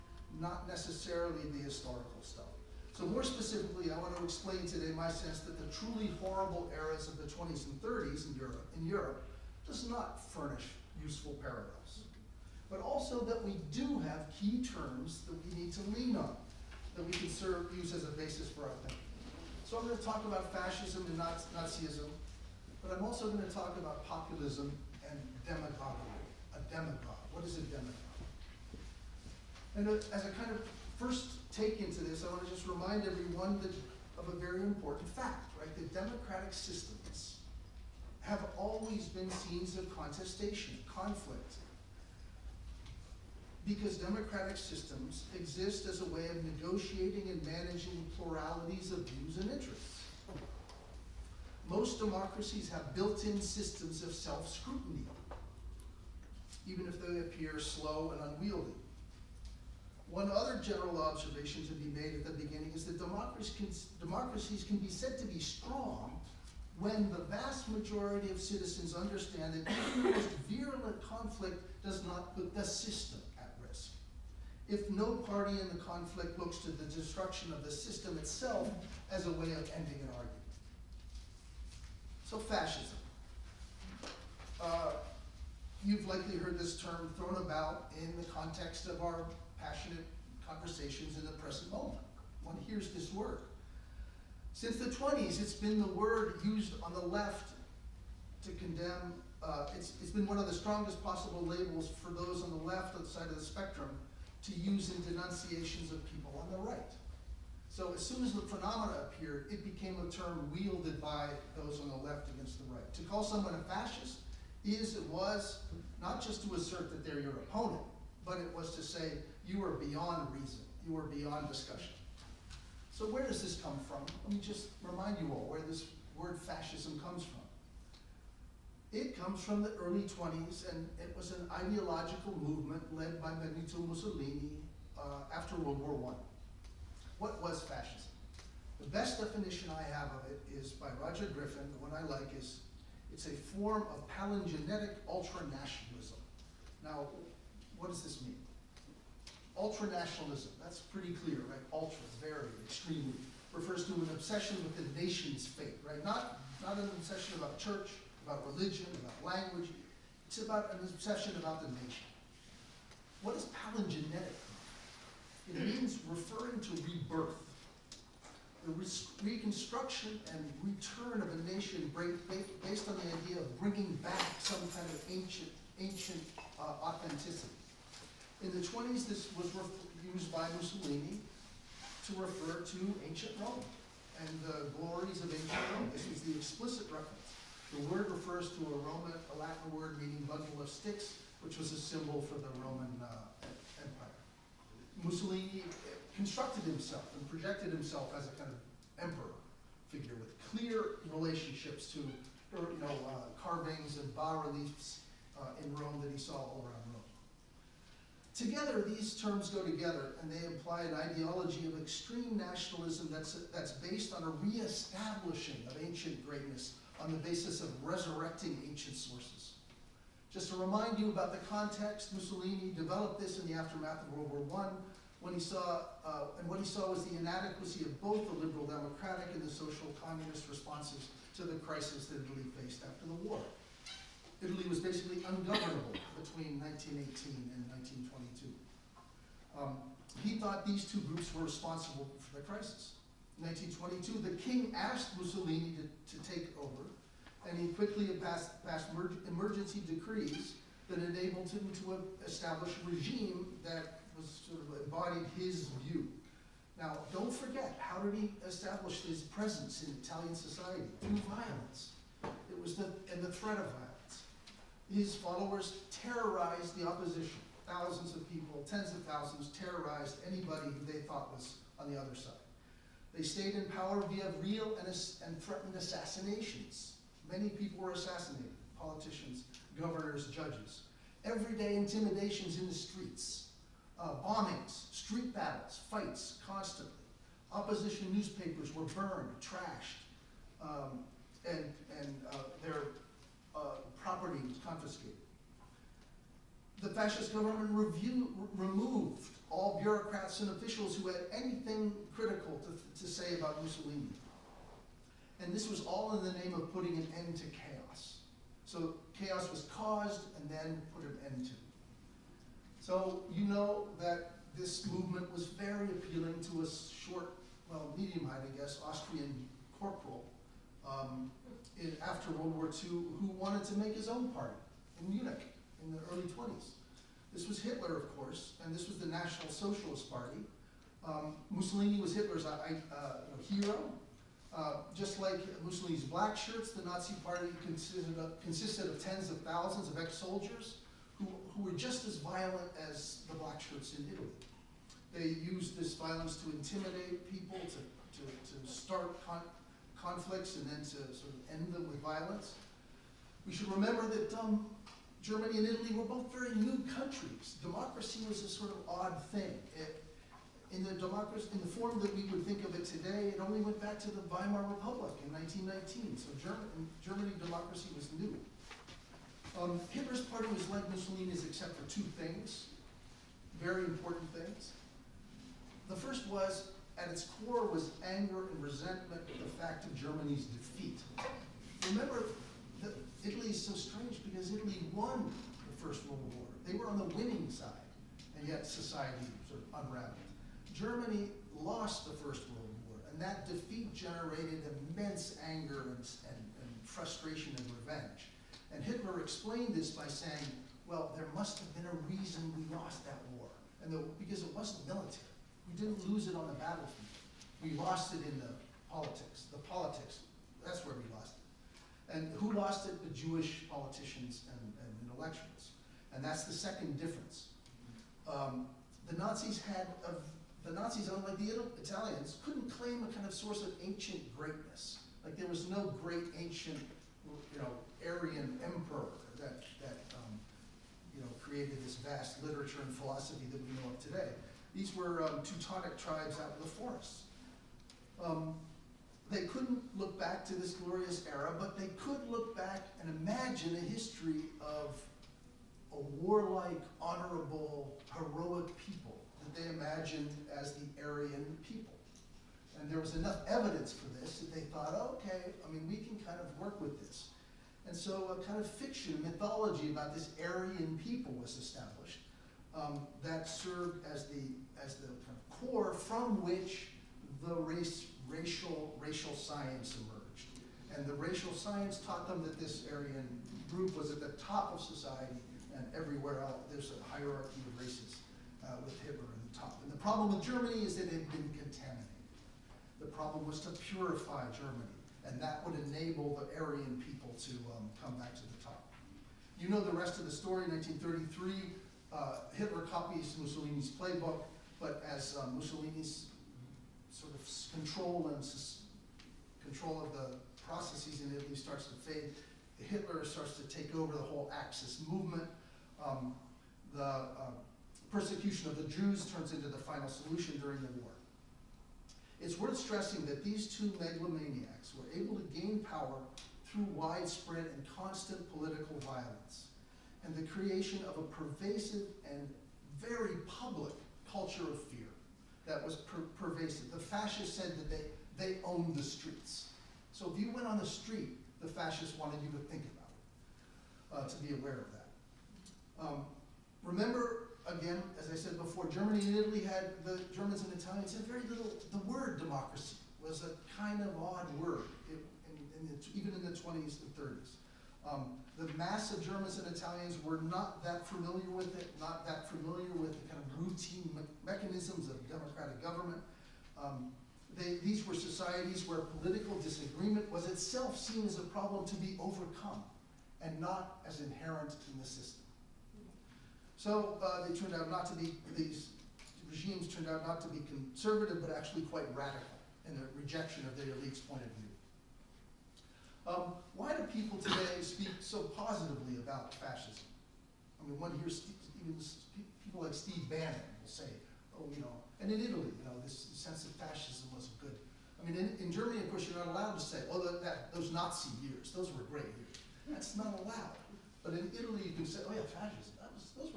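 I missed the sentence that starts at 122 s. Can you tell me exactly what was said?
So where does this come from?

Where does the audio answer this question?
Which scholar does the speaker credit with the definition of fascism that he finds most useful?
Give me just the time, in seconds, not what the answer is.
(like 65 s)
141 s.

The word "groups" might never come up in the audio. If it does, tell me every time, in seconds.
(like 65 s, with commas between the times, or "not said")
241 s, 473 s.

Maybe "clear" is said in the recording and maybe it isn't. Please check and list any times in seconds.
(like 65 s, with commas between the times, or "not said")
151 s, 200 s.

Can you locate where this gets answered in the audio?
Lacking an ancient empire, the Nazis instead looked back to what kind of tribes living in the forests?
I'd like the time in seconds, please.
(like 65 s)
435 s.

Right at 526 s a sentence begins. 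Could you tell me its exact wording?
The fascists said that they, they owned the streets.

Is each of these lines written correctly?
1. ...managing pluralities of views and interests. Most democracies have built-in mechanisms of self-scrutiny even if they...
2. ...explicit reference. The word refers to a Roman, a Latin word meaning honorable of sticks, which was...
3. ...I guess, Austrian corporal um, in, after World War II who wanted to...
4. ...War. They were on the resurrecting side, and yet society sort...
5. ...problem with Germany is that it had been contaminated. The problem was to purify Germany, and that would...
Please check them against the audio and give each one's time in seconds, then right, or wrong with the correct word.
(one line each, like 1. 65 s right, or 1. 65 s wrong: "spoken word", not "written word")
1. 47 s wrong: "systems", not "mechanisms"
2. 186 s wrong: "bundle", not "honorable"
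3. 318 s right
4. 386 s wrong: "winning", not "resurrecting"
5. 479 s right.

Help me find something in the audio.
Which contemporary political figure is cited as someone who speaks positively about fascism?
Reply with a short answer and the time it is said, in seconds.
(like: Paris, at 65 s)
Steve Bannon, at 582 s.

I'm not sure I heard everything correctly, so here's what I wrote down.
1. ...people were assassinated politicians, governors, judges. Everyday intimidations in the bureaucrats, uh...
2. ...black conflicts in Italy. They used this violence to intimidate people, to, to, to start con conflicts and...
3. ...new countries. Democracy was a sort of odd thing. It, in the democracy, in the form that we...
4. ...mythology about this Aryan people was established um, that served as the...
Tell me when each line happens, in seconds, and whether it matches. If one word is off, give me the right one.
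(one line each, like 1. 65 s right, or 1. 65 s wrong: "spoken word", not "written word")
1. 277 s wrong: "streets", not "bureaucrats"
2. 343 s wrong: "shirts", not "conflicts"
3. 356 s right
4. 459 s right.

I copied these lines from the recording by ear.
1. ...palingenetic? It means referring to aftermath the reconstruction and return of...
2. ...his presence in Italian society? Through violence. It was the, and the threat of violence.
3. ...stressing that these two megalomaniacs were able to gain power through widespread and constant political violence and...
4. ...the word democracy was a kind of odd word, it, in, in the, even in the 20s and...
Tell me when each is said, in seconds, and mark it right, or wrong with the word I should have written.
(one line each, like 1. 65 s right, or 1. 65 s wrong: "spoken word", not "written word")
1. 163 s wrong: "rebirth", not "aftermath"
2. 259 s right
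3. 512 s right
4. 541 s right.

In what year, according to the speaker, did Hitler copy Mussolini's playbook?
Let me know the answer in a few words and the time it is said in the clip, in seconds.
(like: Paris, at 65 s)
1933, at 490 s.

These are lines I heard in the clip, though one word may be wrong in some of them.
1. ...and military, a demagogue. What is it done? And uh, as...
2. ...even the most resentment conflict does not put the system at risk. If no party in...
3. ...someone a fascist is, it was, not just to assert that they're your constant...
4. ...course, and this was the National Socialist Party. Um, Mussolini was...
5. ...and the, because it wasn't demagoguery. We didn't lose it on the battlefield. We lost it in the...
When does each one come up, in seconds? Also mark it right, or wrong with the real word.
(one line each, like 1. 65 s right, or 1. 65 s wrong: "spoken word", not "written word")
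1. 25 s wrong: "demagoguery", not "military"
2. 69 s wrong: "virulent", not "resentment"
3. 113 s wrong: "opponent", not "constant"
4. 328 s right
5. 403 s wrong: "military", not "demagoguery".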